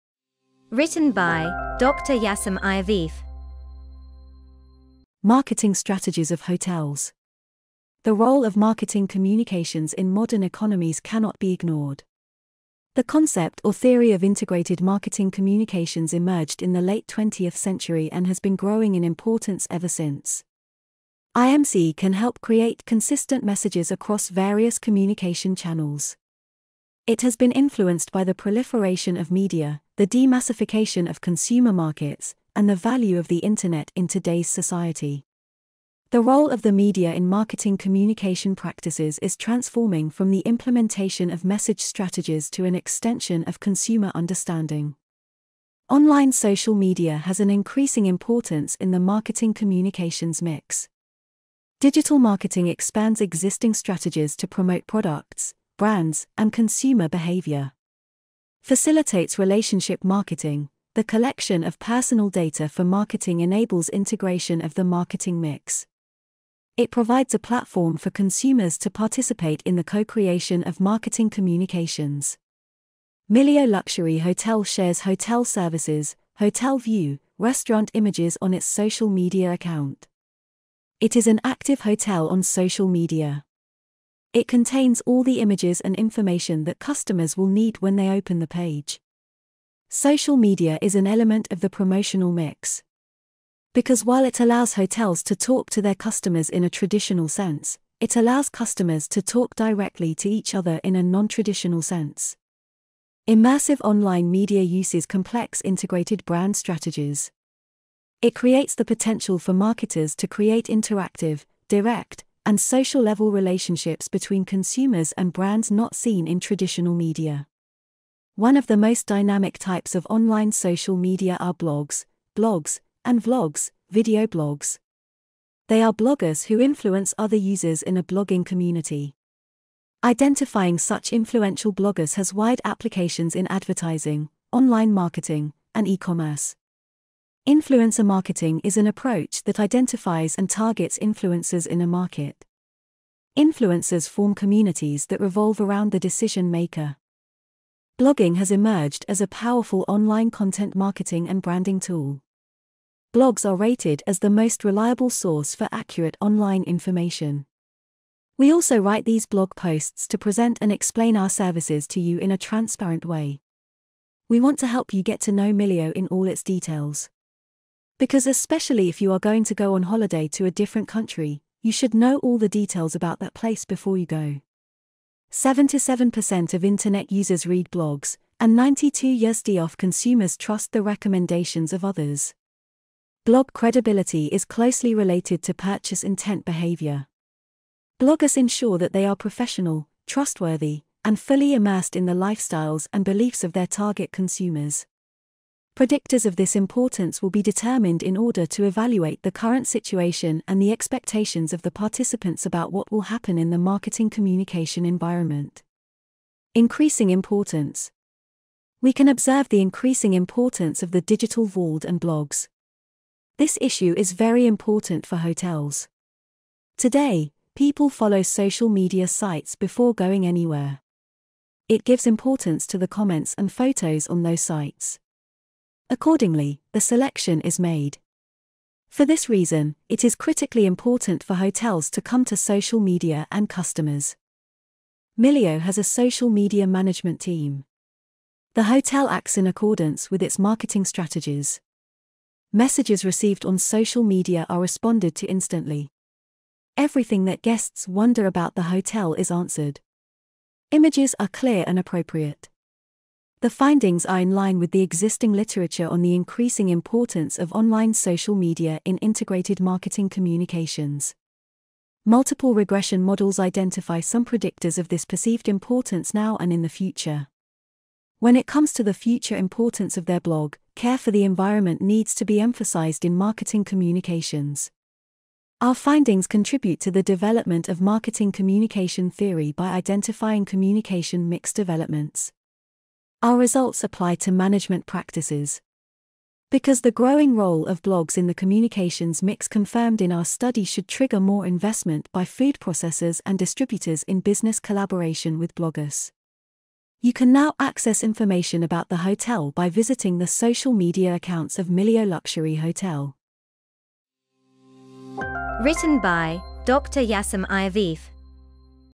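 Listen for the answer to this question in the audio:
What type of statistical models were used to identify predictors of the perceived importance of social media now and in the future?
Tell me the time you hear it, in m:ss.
4:22.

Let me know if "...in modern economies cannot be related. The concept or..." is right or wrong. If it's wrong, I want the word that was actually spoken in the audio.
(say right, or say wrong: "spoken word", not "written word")
wrong: "ignored", not "related".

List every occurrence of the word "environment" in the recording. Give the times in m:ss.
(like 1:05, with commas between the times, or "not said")
3:24, 4:31.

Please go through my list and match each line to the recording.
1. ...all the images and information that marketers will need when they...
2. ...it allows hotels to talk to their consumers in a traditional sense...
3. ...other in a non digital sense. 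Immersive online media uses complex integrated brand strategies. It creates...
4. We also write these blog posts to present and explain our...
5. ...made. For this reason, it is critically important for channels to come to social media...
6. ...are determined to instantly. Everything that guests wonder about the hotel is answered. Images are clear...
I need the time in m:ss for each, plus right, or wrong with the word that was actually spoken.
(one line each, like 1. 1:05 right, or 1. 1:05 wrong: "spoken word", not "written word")
1. 1:25 wrong: "customers", not "marketers"
2. 1:34 wrong: "customers", not "consumers"
3. 1:40 wrong: "traditional", not "digital"
4. 2:38 right
5. 3:47 wrong: "hotels", not "channels"
6. 4:04 wrong: "responded", not "determined".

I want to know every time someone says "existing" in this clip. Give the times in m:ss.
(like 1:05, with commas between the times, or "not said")
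0:53, 4:14.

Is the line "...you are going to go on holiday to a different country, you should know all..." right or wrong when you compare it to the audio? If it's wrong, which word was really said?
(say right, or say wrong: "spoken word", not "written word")
right.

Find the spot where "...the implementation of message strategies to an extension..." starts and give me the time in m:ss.
0:40.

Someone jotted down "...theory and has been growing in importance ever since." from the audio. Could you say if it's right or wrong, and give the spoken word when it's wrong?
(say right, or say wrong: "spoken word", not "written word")
wrong: "century", not "theory".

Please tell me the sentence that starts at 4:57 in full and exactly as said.
You can now access information about the hotel by visiting the social media accounts of Mileo Luxury Hotel.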